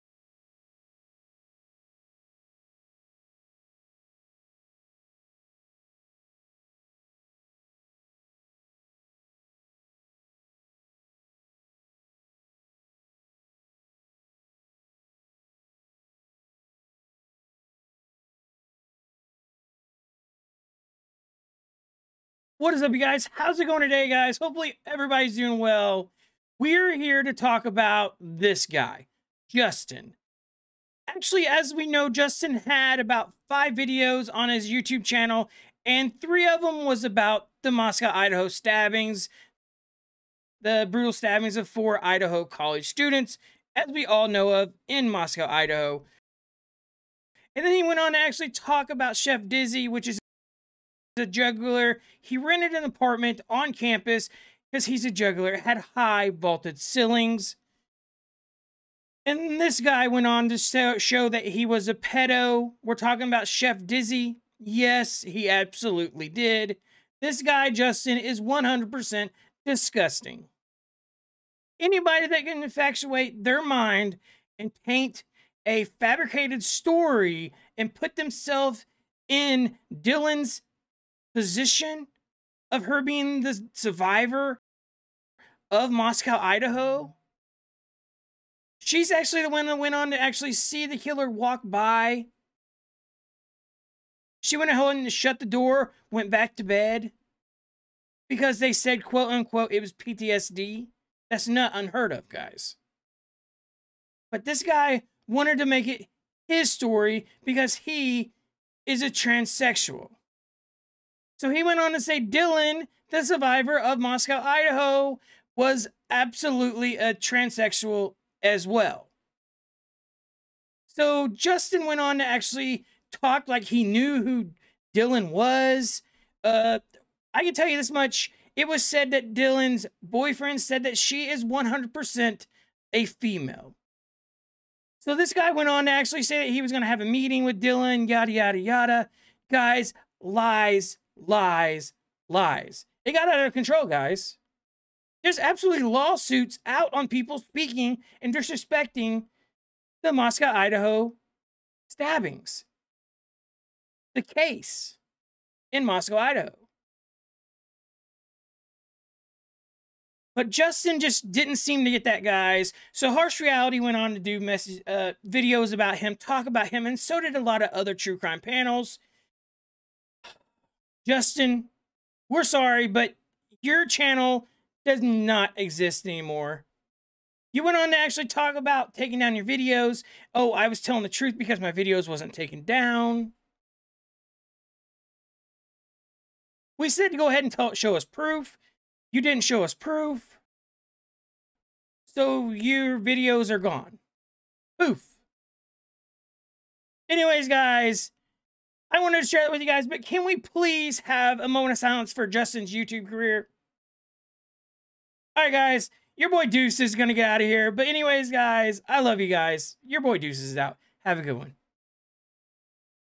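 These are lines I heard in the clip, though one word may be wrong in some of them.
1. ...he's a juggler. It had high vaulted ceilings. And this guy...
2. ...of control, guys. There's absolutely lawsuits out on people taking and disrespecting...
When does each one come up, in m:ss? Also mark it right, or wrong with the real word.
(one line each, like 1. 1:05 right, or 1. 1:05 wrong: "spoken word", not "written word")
1. 0:54 right
2. 2:23 wrong: "speaking", not "taking".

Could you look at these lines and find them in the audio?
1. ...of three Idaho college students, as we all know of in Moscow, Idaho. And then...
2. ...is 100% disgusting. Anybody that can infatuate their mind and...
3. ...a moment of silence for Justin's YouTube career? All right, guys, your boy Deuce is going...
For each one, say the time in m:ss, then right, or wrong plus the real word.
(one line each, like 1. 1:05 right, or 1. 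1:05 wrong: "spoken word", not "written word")
1. 0:41 wrong: "four", not "three"
2. 1:08 right
3. 3:21 right.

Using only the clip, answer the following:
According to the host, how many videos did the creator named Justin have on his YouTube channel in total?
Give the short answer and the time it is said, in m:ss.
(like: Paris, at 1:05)
5, at 0:33.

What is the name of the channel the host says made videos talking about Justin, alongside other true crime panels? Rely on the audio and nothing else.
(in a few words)
Harsh Reality.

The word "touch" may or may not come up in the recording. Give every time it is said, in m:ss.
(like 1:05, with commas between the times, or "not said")
not said.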